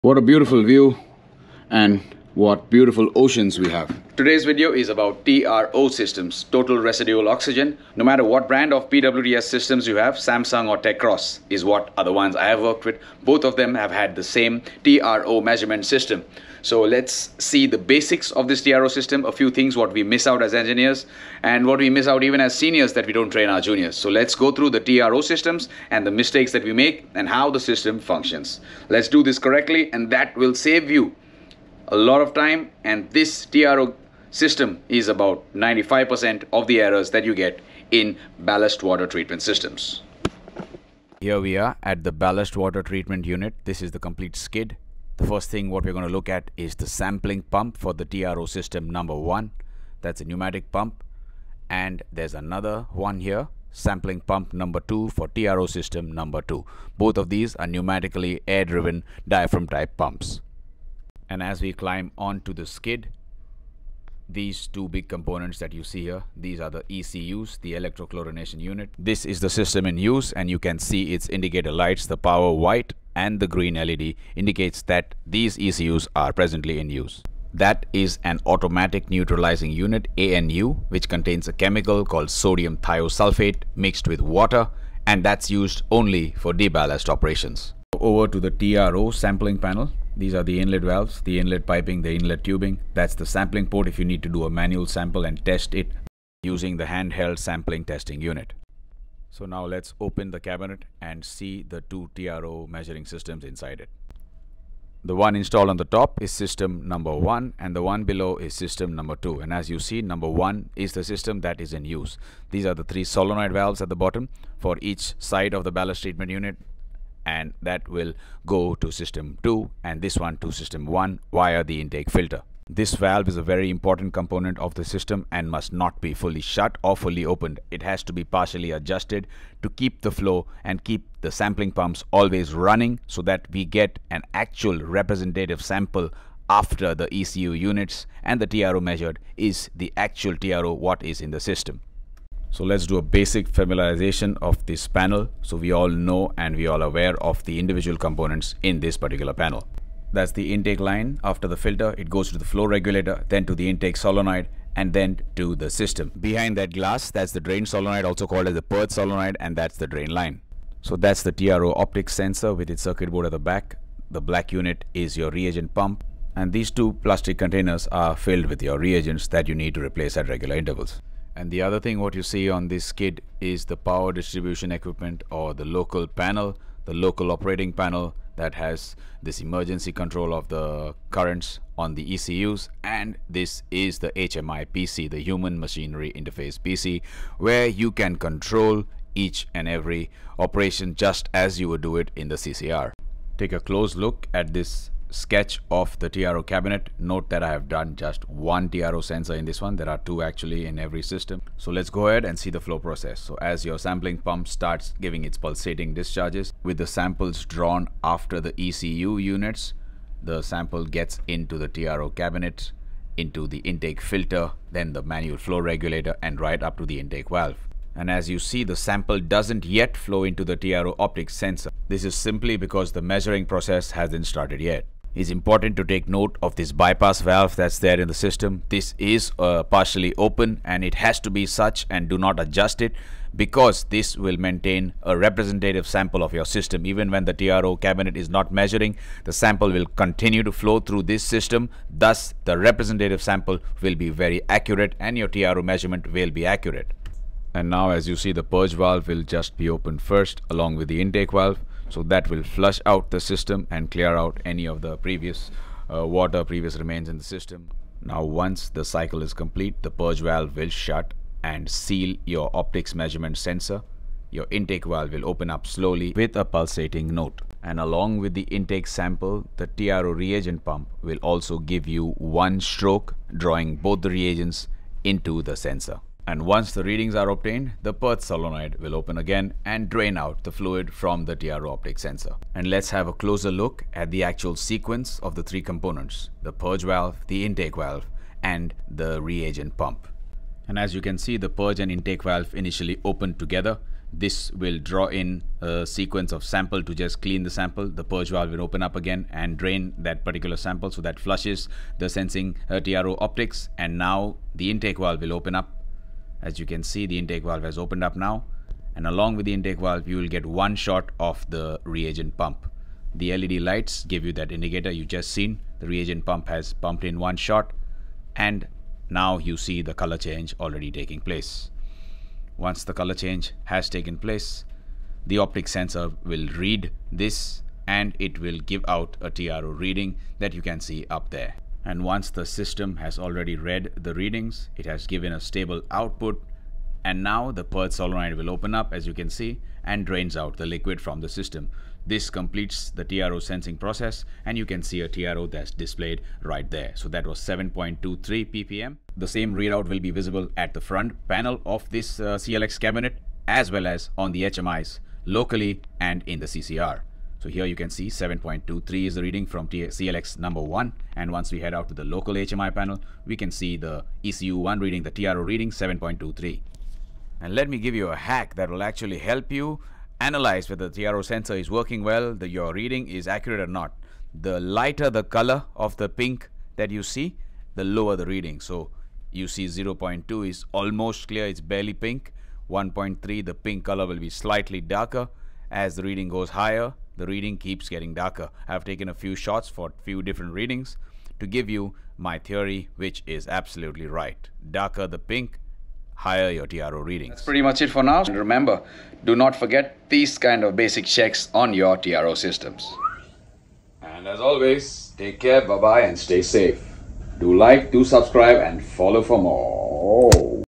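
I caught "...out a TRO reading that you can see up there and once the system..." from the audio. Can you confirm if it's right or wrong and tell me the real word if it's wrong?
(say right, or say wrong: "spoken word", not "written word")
right.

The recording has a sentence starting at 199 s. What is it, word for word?
There are two actually in every system.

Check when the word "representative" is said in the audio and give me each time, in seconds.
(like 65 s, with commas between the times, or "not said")
134 s, 235 s, 242 s.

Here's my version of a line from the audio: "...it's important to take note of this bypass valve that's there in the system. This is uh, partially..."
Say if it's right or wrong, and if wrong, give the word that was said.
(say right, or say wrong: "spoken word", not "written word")
right.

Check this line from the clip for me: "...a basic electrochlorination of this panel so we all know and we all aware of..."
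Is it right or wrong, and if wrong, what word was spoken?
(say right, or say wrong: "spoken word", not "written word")
wrong: "familiarization", not "electrochlorination".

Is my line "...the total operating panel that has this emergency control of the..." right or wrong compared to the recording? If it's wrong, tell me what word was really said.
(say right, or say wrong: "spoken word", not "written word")
wrong: "local", not "total".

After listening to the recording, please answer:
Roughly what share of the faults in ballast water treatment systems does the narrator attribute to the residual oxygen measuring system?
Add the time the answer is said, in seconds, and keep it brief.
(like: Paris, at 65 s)
95%, at 35 s.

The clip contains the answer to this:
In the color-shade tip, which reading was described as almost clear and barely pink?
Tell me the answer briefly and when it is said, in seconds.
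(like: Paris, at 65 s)
0.2, at 379 s.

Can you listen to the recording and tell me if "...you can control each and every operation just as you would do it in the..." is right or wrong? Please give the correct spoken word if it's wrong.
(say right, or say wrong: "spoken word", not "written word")
right.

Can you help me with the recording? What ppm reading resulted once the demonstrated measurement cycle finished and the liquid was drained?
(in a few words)
7.23 ppm.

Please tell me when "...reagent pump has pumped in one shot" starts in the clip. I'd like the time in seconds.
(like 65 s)
315 s.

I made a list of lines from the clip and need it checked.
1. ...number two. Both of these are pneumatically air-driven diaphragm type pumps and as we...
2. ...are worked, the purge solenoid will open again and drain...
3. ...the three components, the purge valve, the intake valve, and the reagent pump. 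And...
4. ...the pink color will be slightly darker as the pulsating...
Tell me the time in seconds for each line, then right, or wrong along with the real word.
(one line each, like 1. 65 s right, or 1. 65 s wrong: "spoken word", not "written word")
1. 56 s right
2. 277 s wrong: "obtained", not "worked"
3. 285 s right
4. 383 s wrong: "reading", not "pulsating".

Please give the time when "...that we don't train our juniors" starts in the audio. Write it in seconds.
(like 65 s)
22 s.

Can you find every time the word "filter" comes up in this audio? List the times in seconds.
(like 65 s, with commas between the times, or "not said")
122 s, 151 s, 214 s.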